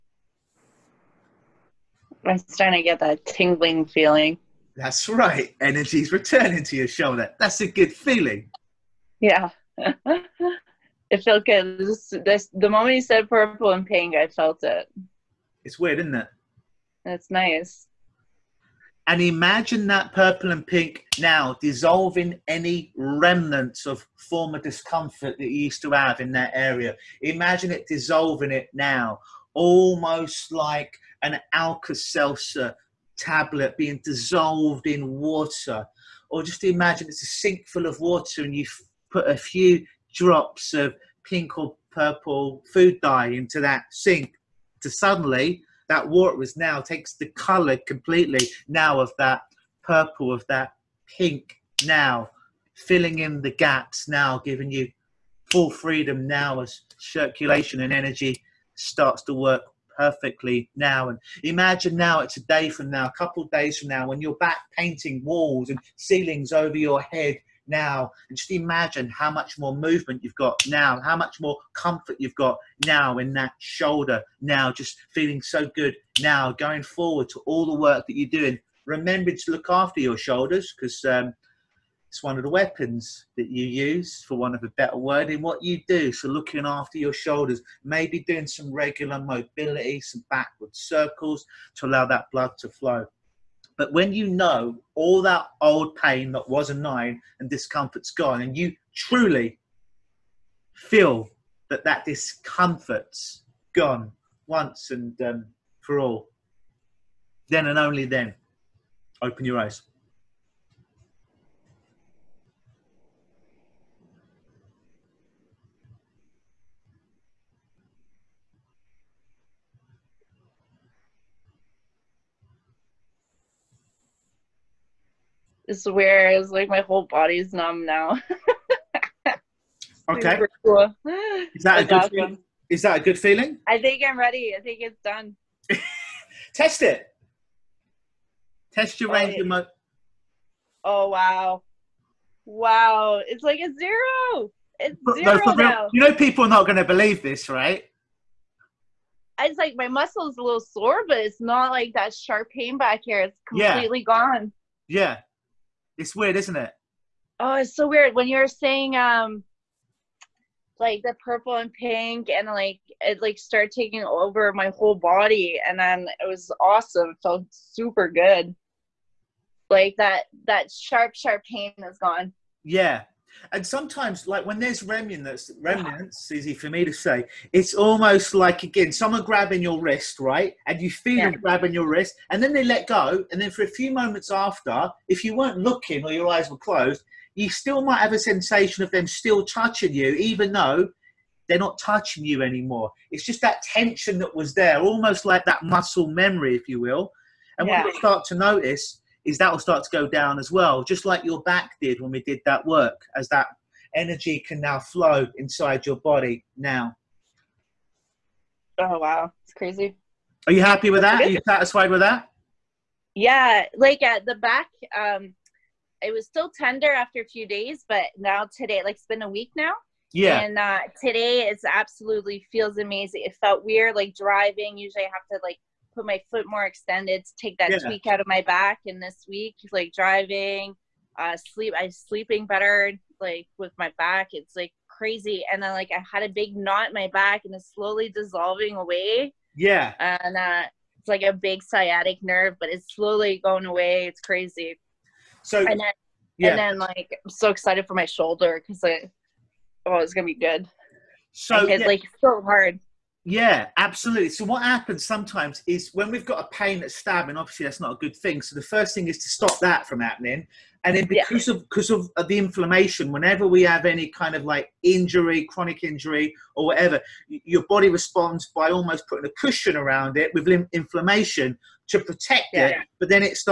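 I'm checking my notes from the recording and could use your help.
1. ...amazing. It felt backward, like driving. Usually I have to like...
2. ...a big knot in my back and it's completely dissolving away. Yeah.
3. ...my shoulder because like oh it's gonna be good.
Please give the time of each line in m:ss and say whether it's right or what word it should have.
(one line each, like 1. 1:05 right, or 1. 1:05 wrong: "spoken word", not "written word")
1. 3:42 wrong: "weird", not "backward"
2. 3:56 wrong: "slowly", not "completely"
3. 4:07 right.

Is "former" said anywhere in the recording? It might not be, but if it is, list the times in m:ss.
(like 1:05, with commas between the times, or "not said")
0:24.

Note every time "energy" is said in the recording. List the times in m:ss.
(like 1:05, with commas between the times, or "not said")
0:05, 0:57, 3:23.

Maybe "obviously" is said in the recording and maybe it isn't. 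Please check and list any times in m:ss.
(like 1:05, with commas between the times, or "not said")
4:17.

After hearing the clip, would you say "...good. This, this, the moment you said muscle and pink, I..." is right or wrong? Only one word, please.
wrong.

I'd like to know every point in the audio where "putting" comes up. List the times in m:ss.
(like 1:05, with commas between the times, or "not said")
4:29.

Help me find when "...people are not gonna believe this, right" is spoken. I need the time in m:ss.
2:26.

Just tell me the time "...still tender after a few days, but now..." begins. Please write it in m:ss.
3:36.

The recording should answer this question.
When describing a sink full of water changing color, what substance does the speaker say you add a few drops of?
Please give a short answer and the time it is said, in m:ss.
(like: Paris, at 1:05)
food dye, at 0:42.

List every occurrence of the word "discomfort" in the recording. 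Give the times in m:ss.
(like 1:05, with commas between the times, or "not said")
0:24, 1:37, 1:42.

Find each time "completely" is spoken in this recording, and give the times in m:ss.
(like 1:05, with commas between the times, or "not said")
0:47, 2:33.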